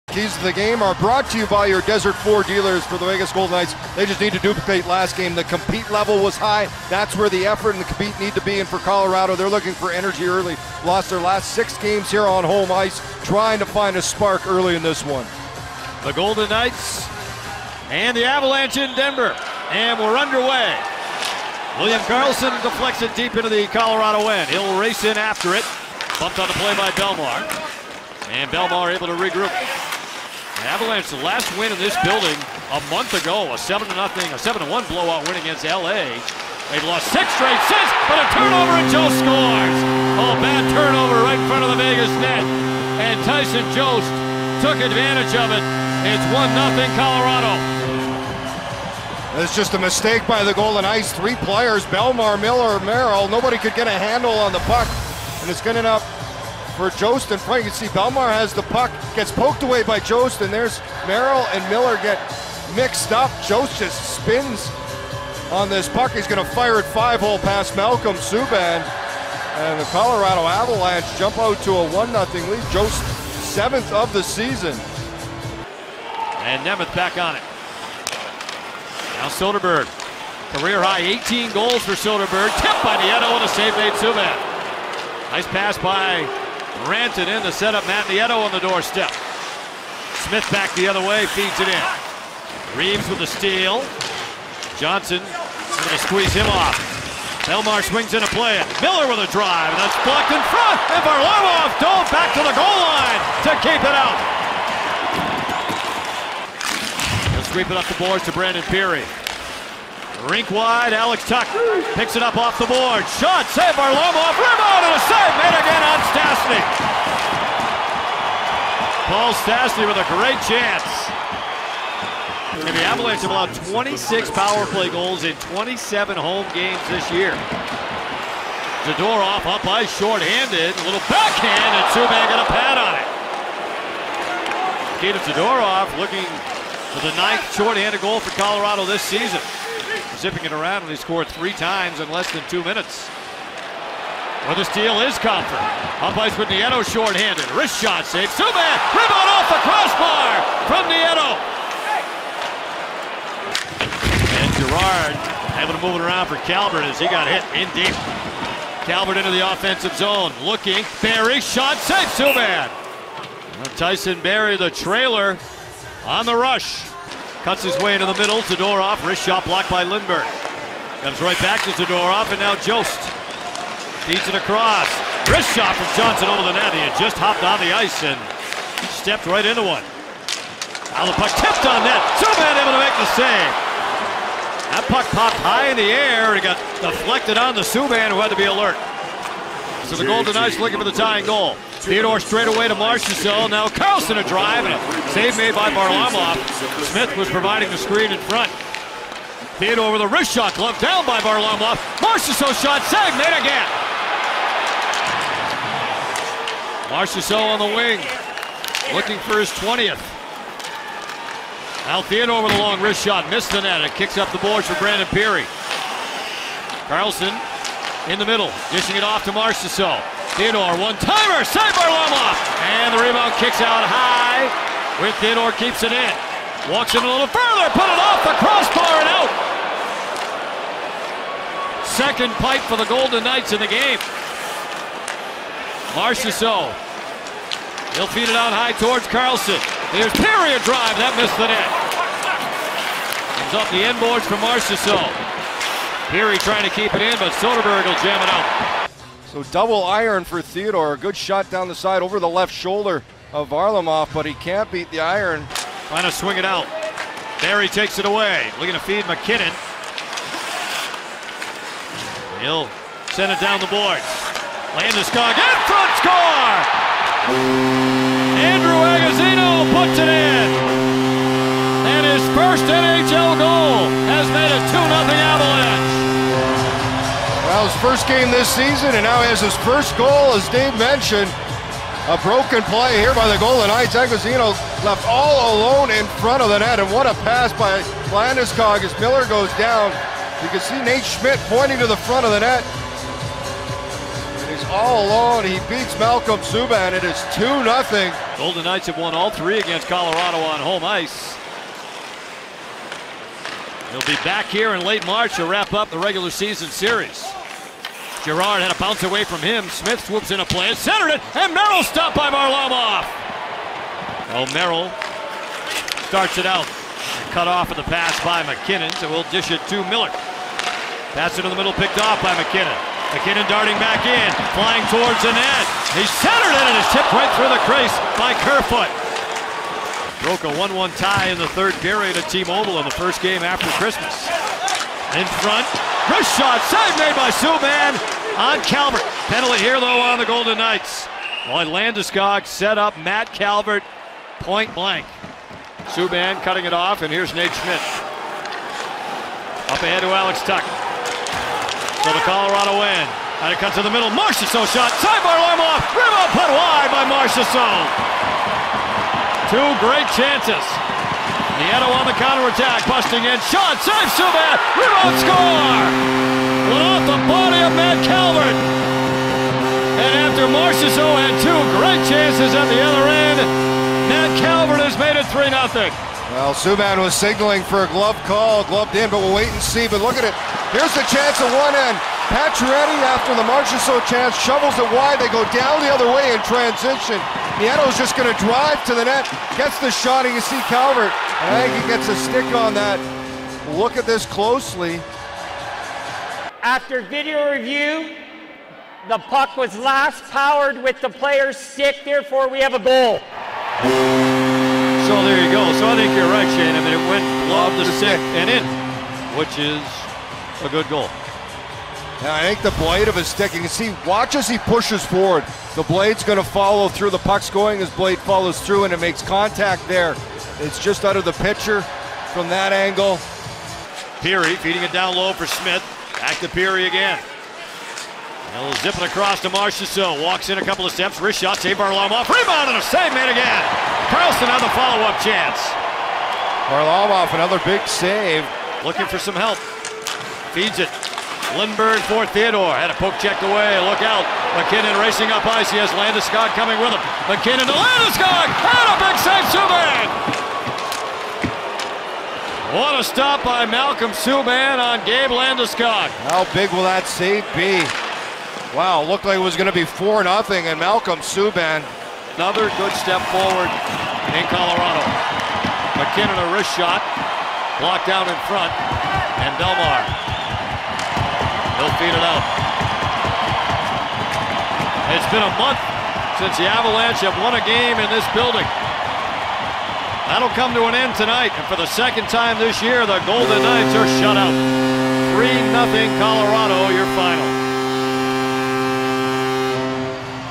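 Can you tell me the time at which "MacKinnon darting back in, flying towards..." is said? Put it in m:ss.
5:23.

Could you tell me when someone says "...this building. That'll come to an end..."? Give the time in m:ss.
7:58.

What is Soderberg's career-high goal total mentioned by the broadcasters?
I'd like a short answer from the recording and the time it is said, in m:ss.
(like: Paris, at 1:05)
18, at 1:20.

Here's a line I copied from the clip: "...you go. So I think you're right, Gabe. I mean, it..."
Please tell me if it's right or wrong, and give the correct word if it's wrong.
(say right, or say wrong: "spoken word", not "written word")
wrong: "Shane", not "Gabe".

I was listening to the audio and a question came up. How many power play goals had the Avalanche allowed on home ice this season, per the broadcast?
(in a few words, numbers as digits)
26.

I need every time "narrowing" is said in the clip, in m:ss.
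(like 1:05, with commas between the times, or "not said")
not said.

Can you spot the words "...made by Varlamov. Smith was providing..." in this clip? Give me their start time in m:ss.
3:15.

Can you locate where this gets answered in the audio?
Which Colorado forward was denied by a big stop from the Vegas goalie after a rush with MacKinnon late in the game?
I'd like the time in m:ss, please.
7:35.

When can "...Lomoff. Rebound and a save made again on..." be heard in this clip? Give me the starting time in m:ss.
1:53.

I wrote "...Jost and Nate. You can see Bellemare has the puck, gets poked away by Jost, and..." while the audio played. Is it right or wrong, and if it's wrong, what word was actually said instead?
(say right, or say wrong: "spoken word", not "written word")
wrong: "Frank", not "Nate".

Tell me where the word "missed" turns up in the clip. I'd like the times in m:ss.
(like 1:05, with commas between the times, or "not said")
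3:33, 4:01.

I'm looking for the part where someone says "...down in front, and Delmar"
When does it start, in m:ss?
7:48.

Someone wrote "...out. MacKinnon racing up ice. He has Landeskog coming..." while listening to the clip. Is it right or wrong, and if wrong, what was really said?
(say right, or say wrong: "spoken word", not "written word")
right.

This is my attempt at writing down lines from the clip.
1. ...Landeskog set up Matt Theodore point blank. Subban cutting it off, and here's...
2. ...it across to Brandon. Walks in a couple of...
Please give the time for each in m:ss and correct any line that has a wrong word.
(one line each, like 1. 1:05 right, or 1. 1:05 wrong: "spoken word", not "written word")
1. 5:41 wrong: "Calvert", not "Theodore"
2. 7:08 wrong: "Marchessault", not "Brandon".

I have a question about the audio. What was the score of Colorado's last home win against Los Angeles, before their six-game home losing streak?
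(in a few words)
7 to 1.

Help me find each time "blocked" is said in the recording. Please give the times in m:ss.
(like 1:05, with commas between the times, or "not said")
1:40, 2:49, 7:47.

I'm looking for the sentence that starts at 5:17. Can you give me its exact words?
Cut off of the pass by MacKinnon, so we'll dish it to Miller.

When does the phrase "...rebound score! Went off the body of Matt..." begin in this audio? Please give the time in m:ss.
6:04.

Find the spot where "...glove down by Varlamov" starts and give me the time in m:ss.
3:20.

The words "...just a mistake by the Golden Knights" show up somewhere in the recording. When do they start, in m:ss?
0:49.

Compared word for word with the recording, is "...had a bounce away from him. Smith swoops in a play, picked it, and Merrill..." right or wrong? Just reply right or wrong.
wrong.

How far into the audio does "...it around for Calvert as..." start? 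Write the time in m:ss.
2:35.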